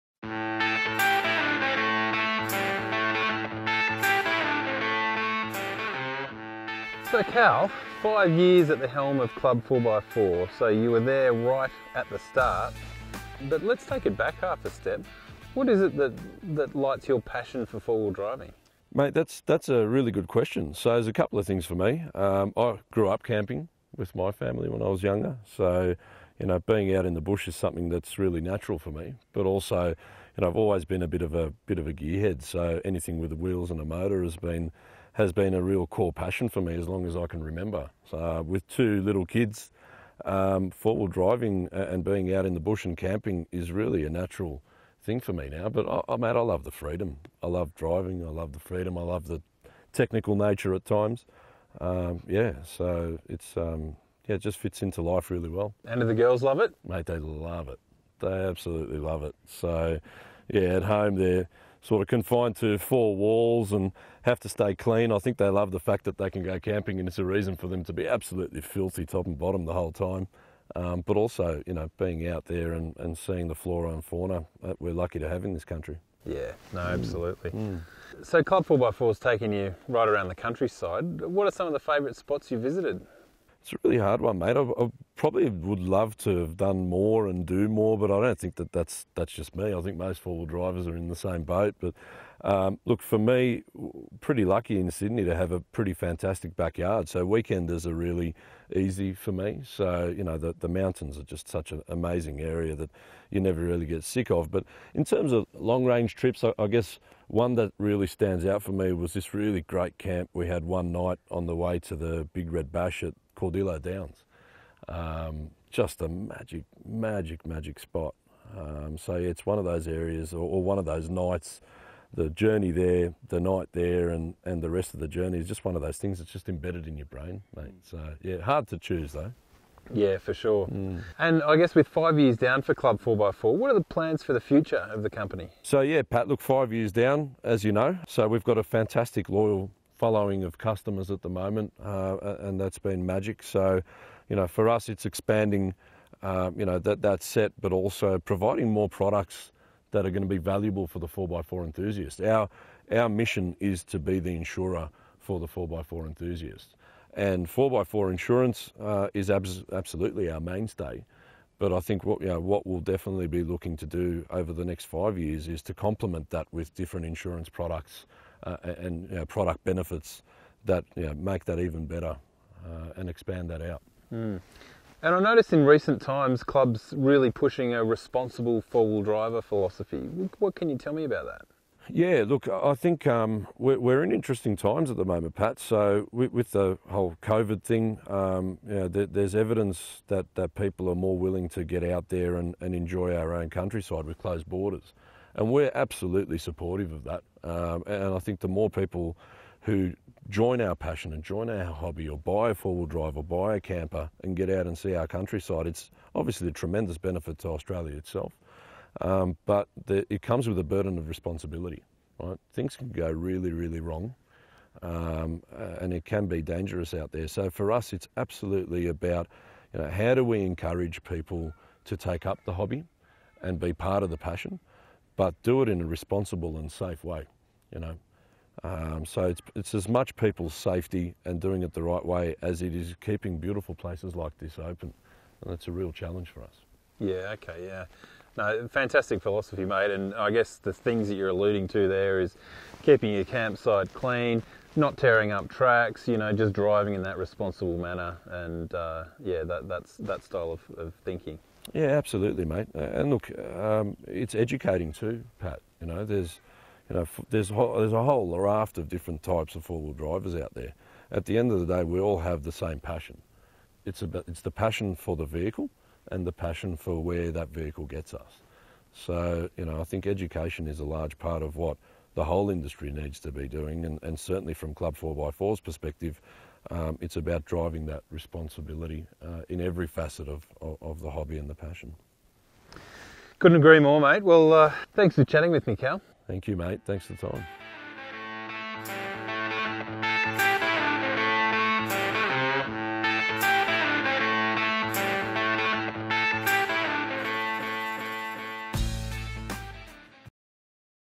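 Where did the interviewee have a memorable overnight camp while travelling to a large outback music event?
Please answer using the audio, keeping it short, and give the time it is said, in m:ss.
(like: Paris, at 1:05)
Cordillo Downs, at 1:53.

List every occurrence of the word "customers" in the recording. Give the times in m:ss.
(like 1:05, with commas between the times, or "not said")
2:20.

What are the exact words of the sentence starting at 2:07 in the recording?
So yeah, hard to choose though.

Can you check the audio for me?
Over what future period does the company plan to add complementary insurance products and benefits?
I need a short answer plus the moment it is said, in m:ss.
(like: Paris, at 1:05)
next 5 years, at 2:44.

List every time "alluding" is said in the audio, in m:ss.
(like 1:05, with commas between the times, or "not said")
4:01.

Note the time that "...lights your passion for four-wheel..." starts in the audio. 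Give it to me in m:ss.
0:16.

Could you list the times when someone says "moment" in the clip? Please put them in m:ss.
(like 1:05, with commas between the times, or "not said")
2:21, 3:05.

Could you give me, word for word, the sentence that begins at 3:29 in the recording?
Um, but the, it comes with a burden of responsibility.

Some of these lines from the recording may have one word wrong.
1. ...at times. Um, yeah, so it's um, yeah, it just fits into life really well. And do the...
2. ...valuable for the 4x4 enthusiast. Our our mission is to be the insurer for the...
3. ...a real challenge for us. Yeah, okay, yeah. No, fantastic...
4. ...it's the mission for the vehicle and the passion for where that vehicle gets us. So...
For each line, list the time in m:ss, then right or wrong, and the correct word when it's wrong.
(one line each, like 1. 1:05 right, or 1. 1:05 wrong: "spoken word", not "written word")
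1. 0:50 right
2. 2:30 right
3. 3:55 right
4. 4:24 wrong: "passion", not "mission".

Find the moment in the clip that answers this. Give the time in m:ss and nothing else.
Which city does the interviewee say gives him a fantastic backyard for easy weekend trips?
1:34.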